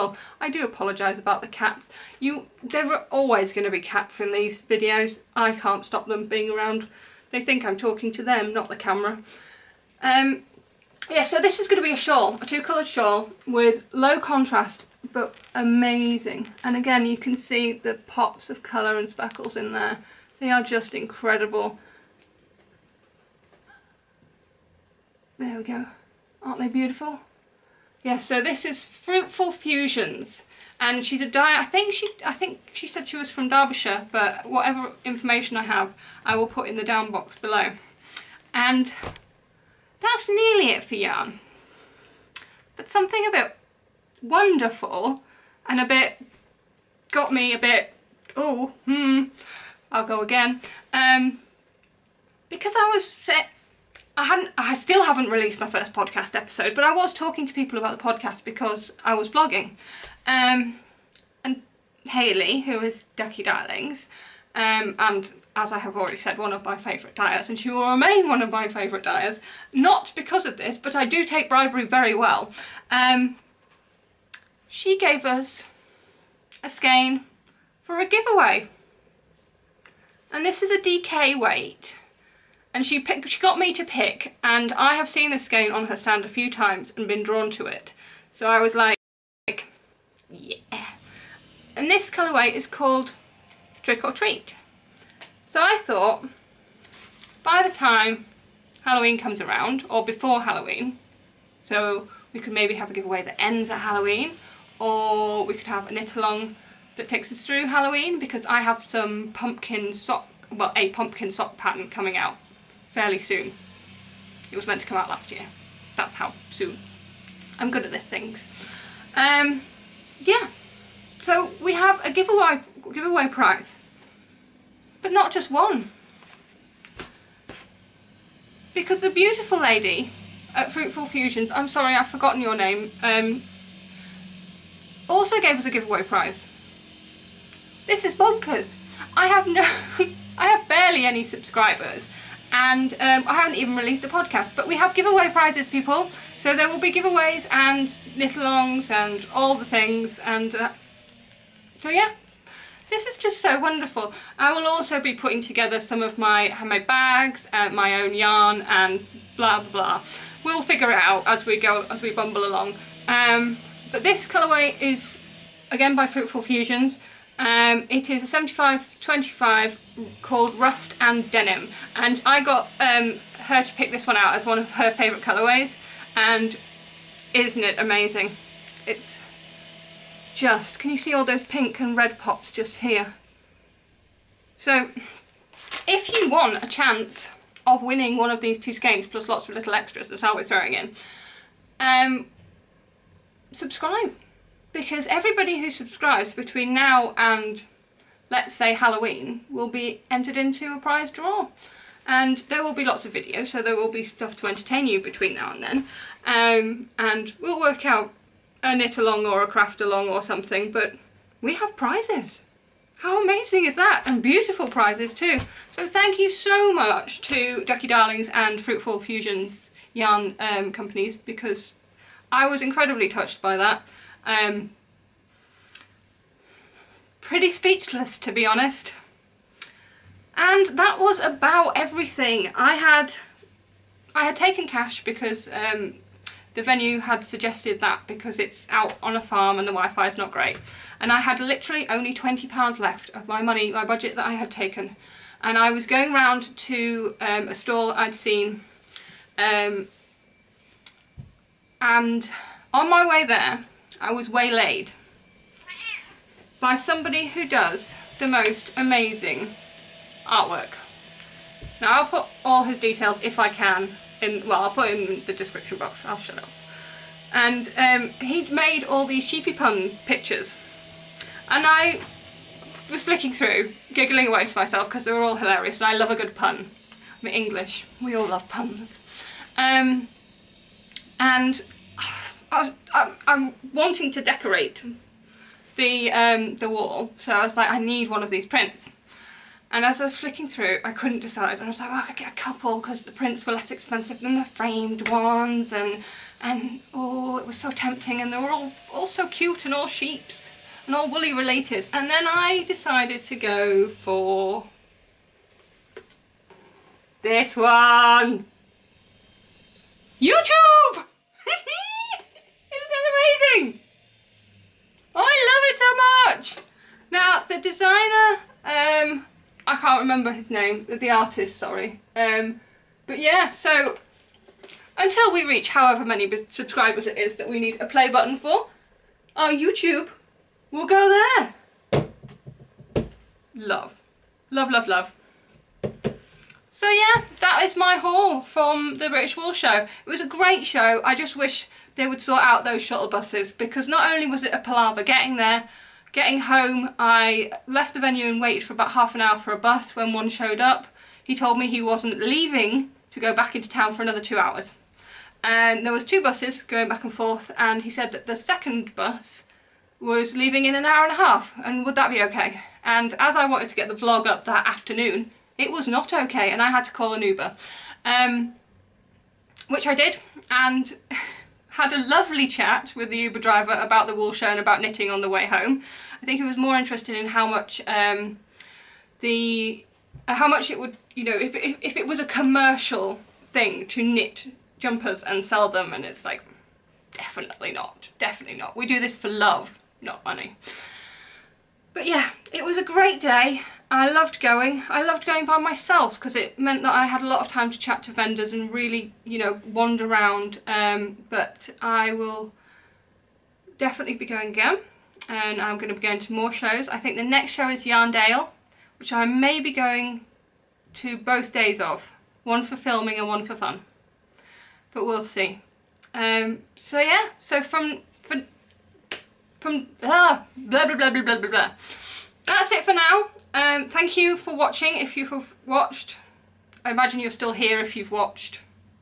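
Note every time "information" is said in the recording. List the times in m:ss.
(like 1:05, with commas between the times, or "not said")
0:35.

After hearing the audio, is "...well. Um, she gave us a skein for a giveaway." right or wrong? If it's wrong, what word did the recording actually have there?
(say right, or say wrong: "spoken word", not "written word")
right.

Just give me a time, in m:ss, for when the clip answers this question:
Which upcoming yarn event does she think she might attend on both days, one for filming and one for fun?
6:47.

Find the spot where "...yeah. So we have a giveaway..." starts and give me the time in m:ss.
2:00.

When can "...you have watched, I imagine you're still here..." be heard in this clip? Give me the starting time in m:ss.
7:05.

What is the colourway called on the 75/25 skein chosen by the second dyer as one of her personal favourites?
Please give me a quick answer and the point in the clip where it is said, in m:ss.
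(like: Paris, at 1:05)
Rust and Denim, at 2:50.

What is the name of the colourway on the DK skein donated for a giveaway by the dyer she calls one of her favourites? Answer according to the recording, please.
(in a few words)
Trick or Treat.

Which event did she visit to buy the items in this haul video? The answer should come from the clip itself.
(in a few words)
British Wool Show.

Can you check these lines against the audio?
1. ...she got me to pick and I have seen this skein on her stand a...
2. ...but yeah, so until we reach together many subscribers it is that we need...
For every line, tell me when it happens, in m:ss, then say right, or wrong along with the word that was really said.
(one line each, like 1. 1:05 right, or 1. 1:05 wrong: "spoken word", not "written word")
1. 1:23 right
2. 5:23 wrong: "however", not "together".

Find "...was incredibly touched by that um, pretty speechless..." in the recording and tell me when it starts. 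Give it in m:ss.
3:42.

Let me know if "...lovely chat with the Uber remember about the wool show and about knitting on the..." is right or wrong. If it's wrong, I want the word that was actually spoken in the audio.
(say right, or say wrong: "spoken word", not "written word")
wrong: "driver", not "remember".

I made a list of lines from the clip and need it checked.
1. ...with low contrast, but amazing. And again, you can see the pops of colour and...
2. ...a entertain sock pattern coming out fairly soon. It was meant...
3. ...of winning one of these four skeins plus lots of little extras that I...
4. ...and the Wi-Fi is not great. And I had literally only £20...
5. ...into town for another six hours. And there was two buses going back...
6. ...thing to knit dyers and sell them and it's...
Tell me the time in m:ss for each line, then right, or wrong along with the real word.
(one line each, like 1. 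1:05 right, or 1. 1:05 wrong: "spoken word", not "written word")
1. 0:13 right
2. 1:50 wrong: "pumpkin", not "entertain"
3. 3:07 wrong: "two", not "four"
4. 3:59 right
5. 5:53 wrong: "two", not "six"
6. 6:23 wrong: "jumpers", not "dyers".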